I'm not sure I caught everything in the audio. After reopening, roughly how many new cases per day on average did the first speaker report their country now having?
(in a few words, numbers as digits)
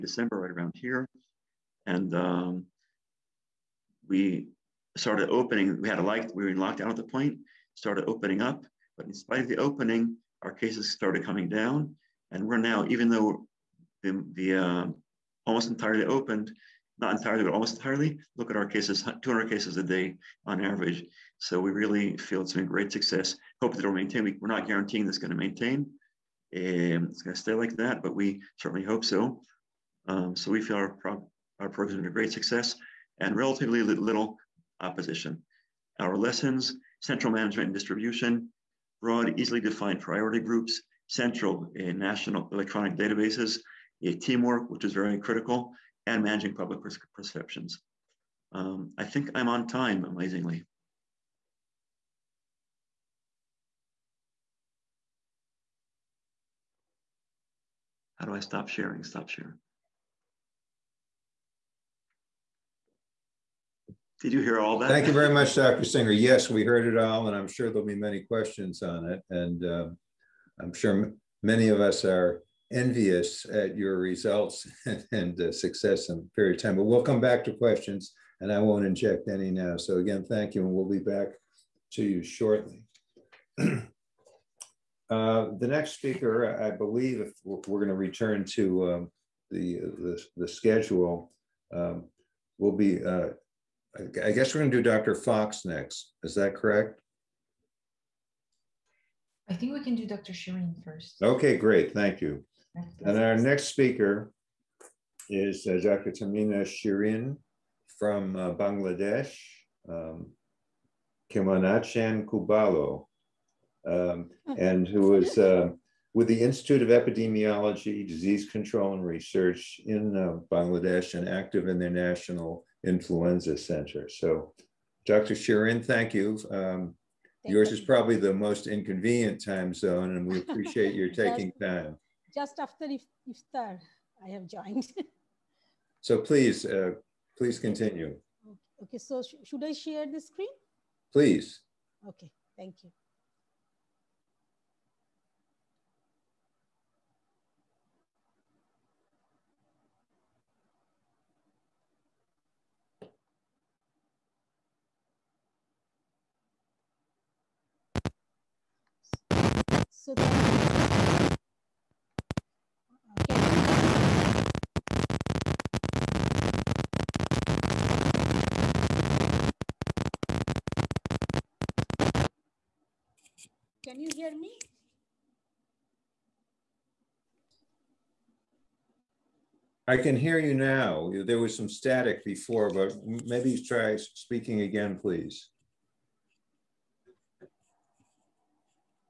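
200.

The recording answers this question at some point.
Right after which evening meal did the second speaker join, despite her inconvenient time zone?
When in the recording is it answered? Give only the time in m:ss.
2:13.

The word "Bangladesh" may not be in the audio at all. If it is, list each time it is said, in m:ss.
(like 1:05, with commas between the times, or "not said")
1:48, 2:00.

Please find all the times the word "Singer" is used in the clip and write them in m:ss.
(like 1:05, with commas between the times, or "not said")
1:05.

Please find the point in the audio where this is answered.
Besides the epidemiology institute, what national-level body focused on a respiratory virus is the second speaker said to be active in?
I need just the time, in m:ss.
2:01.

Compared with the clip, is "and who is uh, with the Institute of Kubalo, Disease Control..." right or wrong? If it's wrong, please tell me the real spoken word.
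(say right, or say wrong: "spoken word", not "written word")
wrong: "Epidemiology", not "Kubalo".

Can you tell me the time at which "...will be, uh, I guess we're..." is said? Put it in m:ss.
1:32.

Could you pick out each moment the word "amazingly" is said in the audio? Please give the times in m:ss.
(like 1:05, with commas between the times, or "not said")
0:50.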